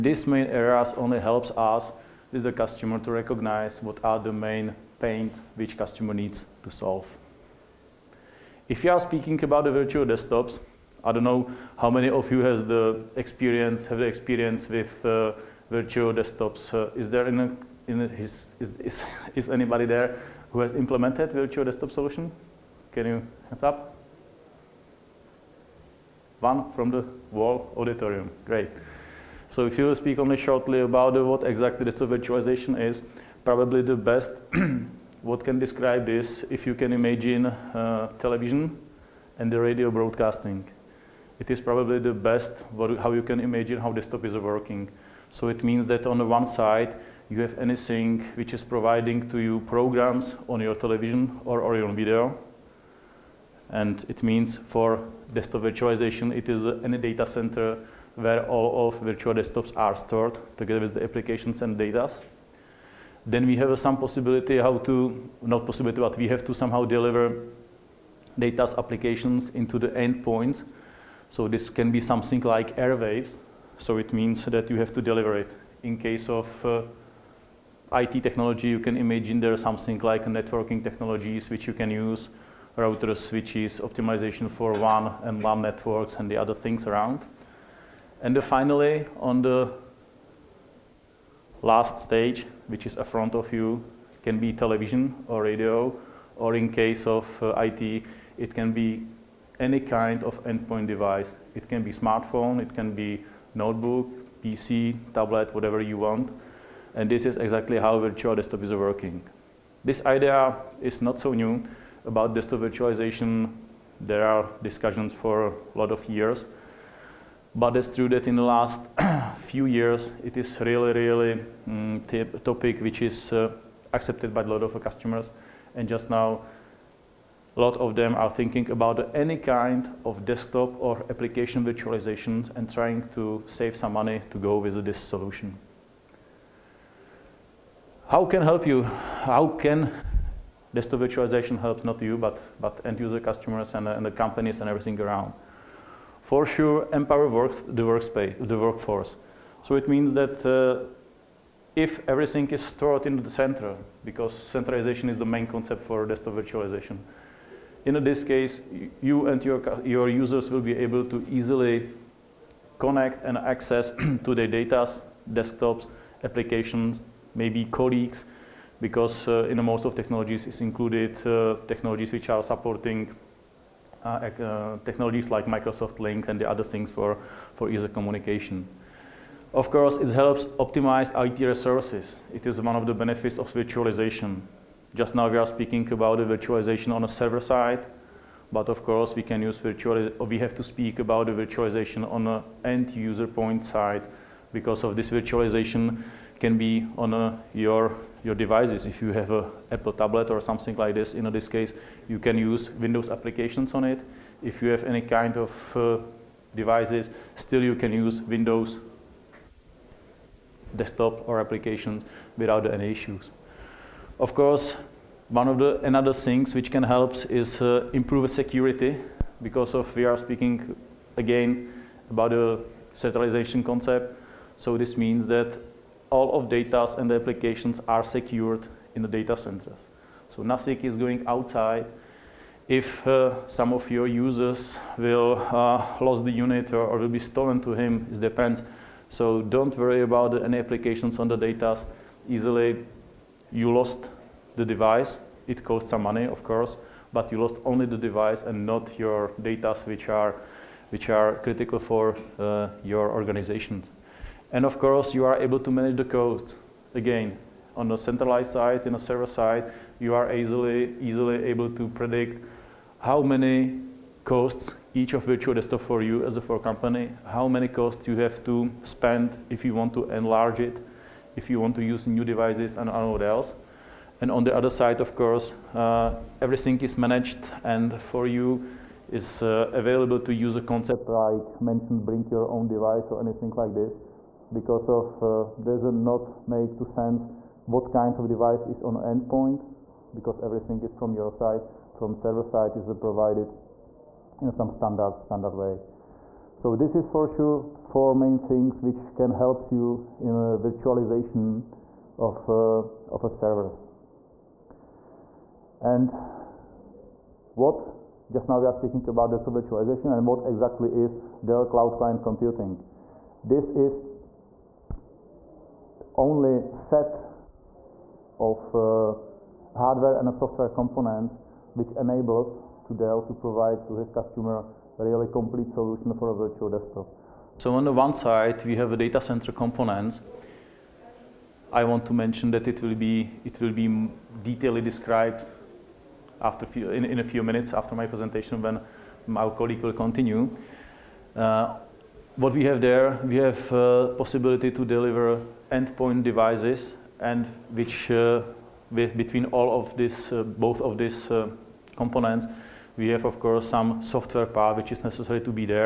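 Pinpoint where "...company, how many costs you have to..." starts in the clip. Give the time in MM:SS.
04:26.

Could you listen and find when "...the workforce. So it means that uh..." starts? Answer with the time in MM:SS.
02:28.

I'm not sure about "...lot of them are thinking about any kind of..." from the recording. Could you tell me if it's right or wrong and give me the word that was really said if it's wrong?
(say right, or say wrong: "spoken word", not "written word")
right.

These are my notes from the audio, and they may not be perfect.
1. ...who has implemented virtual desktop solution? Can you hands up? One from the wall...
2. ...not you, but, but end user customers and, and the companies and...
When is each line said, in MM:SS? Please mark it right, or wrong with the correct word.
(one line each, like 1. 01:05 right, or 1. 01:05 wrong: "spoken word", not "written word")
1. 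00:20 right
2. 02:21 right.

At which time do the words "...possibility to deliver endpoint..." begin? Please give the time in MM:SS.
05:44.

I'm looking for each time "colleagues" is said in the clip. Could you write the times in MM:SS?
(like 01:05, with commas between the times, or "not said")
02:47, 05:39.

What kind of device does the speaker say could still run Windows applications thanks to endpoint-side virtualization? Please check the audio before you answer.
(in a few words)
Apple tablet.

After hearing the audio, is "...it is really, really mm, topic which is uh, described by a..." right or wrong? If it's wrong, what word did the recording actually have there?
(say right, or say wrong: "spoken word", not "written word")
wrong: "accepted", not "described".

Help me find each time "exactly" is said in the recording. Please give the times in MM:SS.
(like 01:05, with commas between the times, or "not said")
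00:31, 01:47, 05:10.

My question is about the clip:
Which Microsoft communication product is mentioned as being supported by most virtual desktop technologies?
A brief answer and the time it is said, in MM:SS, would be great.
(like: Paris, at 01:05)
Microsoft Link, at 02:55.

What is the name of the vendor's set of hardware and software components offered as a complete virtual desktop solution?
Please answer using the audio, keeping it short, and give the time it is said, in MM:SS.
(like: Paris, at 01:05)
Dell Cloud Client Computing, at 05:11.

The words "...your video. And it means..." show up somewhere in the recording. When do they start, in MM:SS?
00:51.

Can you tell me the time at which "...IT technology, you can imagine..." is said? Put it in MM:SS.
01:17.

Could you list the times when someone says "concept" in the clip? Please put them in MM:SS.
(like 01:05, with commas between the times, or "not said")
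02:35, 03:43, 04:40.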